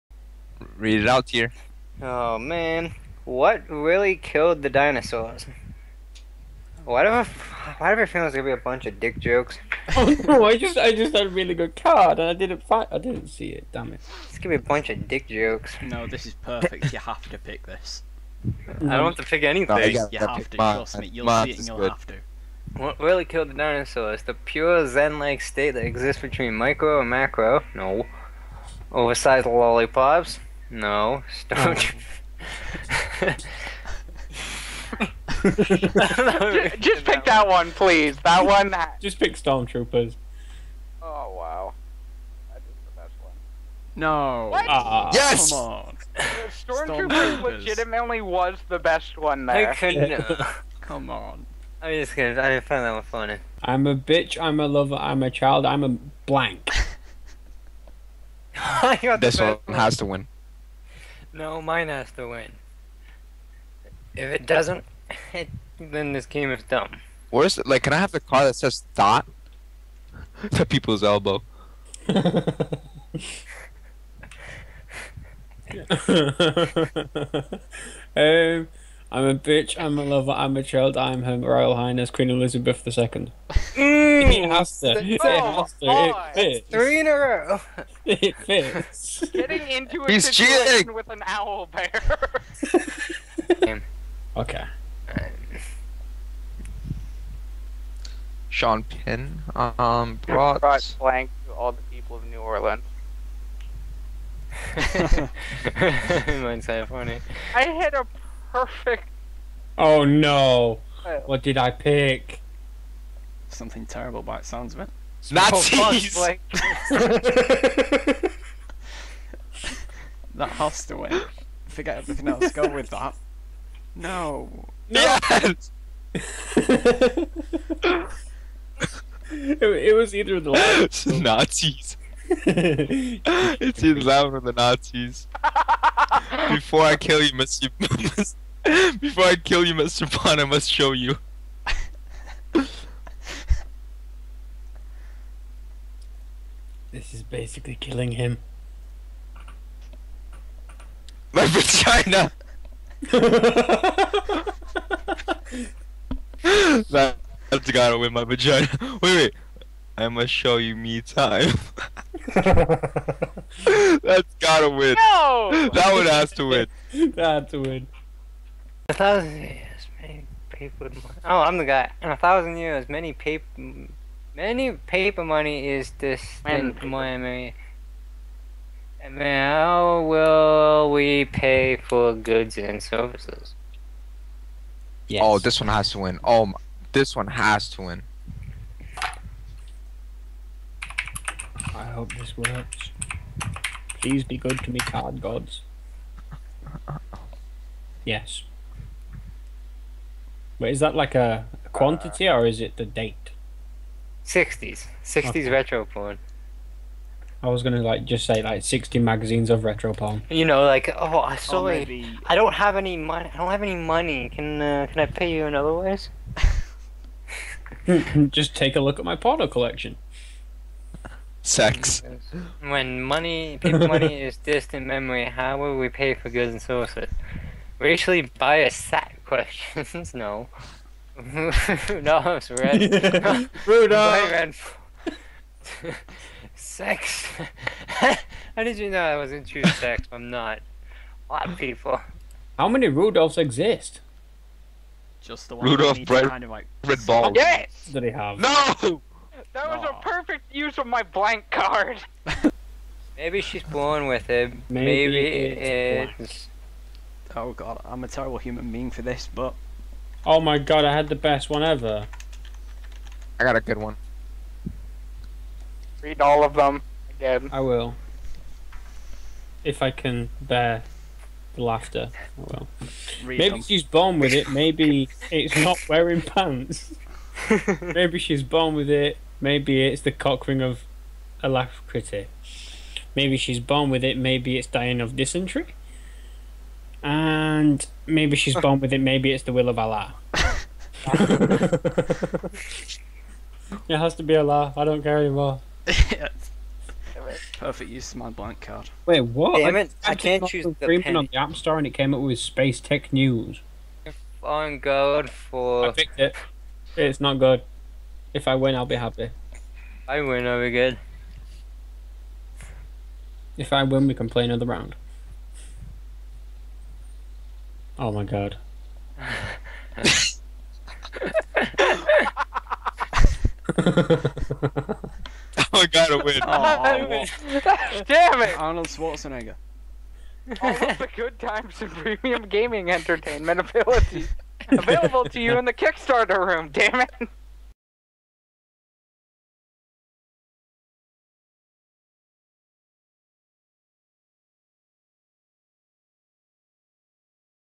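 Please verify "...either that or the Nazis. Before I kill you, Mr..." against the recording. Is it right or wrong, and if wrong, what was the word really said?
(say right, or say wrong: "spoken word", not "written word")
right.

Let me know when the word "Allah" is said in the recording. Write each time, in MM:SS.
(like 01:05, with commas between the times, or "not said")
04:49, 04:54.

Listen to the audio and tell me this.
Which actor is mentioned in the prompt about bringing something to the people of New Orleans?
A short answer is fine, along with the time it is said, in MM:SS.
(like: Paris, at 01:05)
Sean Penn, at 01:38.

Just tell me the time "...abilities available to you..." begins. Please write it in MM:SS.
05:33.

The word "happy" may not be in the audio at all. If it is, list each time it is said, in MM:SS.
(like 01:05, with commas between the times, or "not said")
05:08.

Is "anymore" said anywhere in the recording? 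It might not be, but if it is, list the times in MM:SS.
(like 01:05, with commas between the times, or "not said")
04:55.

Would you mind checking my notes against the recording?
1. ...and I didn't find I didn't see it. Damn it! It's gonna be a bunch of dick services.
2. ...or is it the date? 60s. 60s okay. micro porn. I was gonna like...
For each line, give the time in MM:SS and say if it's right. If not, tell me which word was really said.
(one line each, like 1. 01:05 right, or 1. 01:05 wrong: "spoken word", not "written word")
1. 00:12 wrong: "jokes", not "services"
2. 03:22 wrong: "retro", not "micro".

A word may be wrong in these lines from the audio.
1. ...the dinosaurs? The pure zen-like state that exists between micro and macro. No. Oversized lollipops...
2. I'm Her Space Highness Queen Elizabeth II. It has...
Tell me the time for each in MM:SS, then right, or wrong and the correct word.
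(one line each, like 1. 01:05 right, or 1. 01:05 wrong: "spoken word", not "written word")
1. 00:23 right
2. 01:20 wrong: "Royal", not "Space".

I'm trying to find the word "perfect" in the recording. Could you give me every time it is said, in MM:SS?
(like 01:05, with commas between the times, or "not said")
00:16, 01:48, 04:10, 04:57.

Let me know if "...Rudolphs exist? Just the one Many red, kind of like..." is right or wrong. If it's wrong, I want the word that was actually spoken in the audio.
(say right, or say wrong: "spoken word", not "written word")
wrong: "Rudolph", not "Many".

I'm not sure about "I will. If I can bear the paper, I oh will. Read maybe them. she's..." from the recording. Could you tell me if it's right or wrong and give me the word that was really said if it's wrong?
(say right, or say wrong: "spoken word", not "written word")
wrong: "laughter", not "paper".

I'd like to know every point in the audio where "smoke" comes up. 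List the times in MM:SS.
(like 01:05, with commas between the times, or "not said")
not said.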